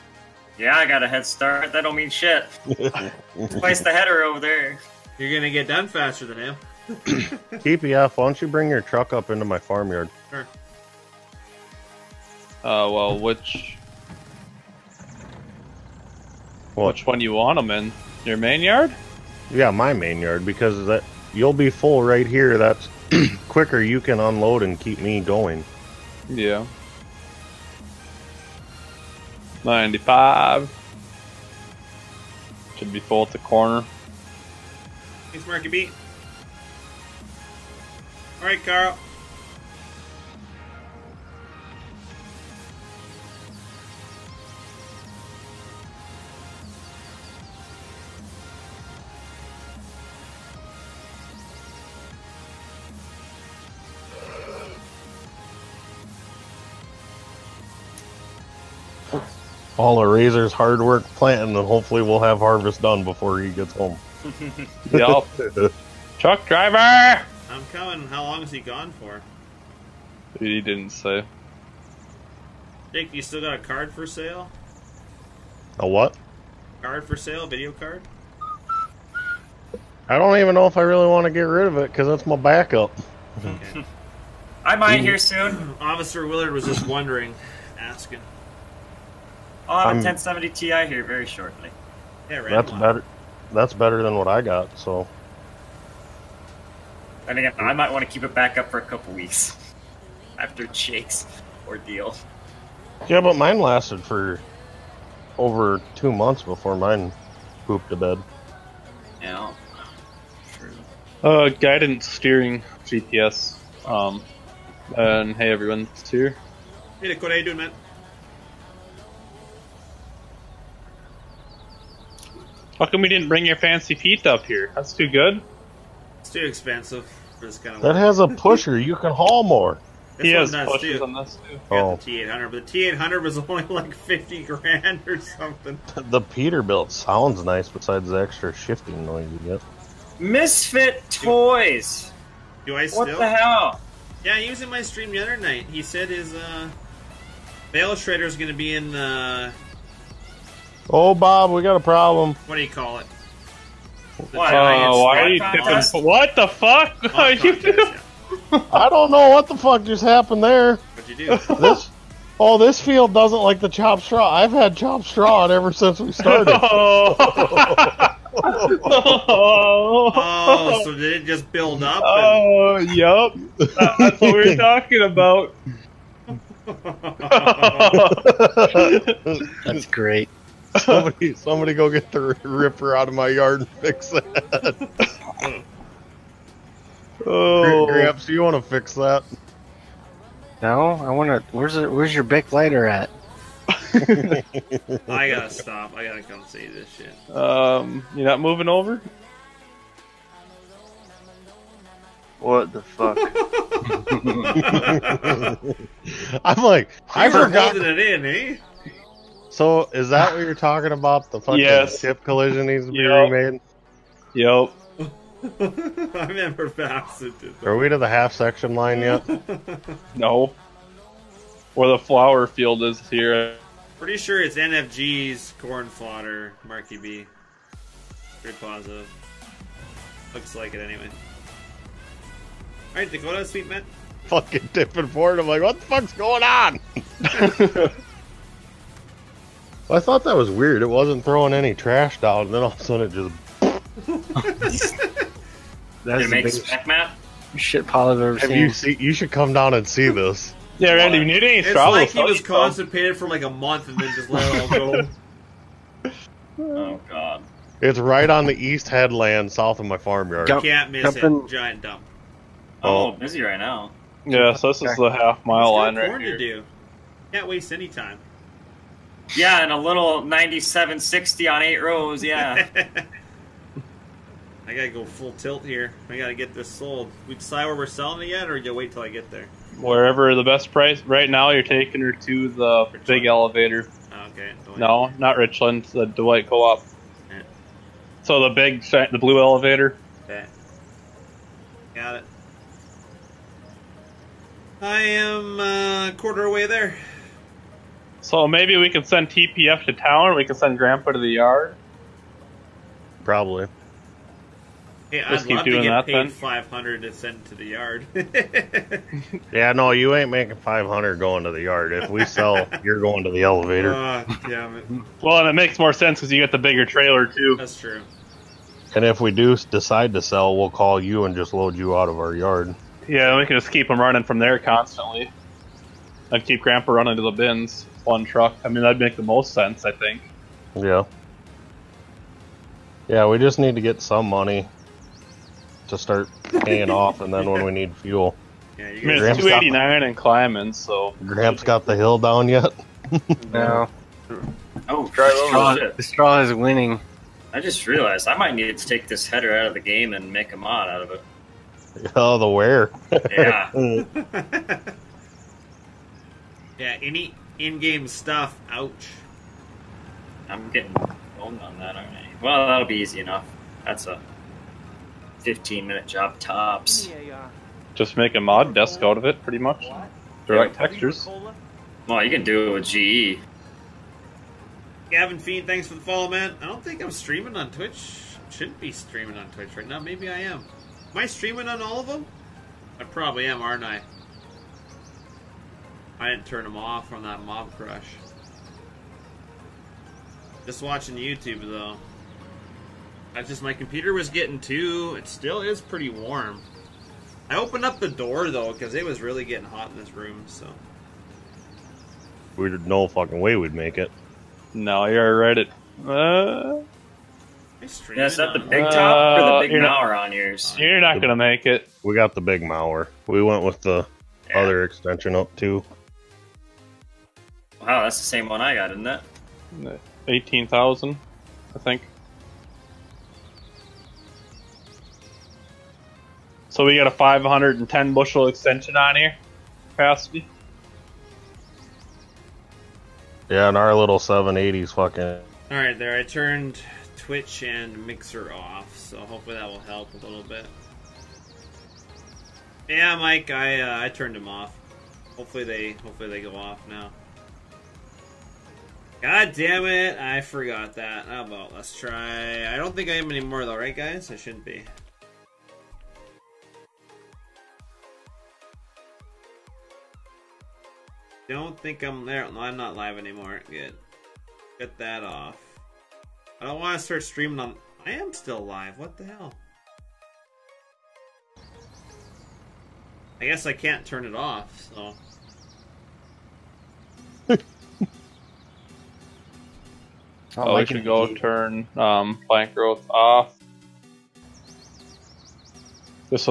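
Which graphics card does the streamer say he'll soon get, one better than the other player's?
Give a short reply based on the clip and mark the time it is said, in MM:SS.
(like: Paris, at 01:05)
1070 Ti, at 01:30.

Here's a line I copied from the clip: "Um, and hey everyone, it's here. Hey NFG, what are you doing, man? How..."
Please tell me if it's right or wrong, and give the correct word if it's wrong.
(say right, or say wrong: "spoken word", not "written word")
wrong: "Nick", not "NFG".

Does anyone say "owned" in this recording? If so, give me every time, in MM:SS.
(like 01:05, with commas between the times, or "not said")
06:01.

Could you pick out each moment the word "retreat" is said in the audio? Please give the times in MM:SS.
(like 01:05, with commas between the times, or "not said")
not said.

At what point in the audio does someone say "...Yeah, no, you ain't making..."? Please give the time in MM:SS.
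05:09.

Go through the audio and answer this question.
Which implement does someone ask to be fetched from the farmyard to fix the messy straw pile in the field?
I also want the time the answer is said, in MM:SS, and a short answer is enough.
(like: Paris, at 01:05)
Ripper, at 03:02.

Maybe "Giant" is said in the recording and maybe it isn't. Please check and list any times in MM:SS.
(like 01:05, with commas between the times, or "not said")
04:21.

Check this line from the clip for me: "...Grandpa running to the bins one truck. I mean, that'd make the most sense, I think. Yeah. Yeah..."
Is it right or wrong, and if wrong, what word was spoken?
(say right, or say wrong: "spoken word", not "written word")
right.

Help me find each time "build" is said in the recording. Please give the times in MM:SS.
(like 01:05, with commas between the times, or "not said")
02:51.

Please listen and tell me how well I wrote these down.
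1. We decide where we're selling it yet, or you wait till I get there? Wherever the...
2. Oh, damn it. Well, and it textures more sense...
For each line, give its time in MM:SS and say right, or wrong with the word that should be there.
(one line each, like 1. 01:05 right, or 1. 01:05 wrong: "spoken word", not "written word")
1. 04:37 right
2. 05:13 wrong: "makes", not "textures".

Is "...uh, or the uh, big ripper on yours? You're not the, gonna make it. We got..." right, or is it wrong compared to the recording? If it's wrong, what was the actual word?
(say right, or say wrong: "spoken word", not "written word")
wrong: "mower", not "ripper".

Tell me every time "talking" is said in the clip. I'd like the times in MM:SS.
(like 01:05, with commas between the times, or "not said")
02:54, 03:30.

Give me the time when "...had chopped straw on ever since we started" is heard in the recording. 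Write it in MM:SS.
02:44.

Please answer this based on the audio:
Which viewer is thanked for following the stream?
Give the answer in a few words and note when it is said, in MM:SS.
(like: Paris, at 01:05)
Gavin Fiend, at 06:15.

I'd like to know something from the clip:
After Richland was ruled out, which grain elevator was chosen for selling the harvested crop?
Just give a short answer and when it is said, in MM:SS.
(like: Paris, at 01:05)
Dwight Co-op, at 04:46.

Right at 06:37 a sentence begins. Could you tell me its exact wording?
I opened up the door though, because it was really getting hot in this room, so.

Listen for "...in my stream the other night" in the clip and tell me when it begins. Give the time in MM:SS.
02:24.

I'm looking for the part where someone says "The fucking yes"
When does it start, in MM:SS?
03:31.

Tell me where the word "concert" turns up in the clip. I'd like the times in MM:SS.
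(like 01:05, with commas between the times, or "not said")
not said.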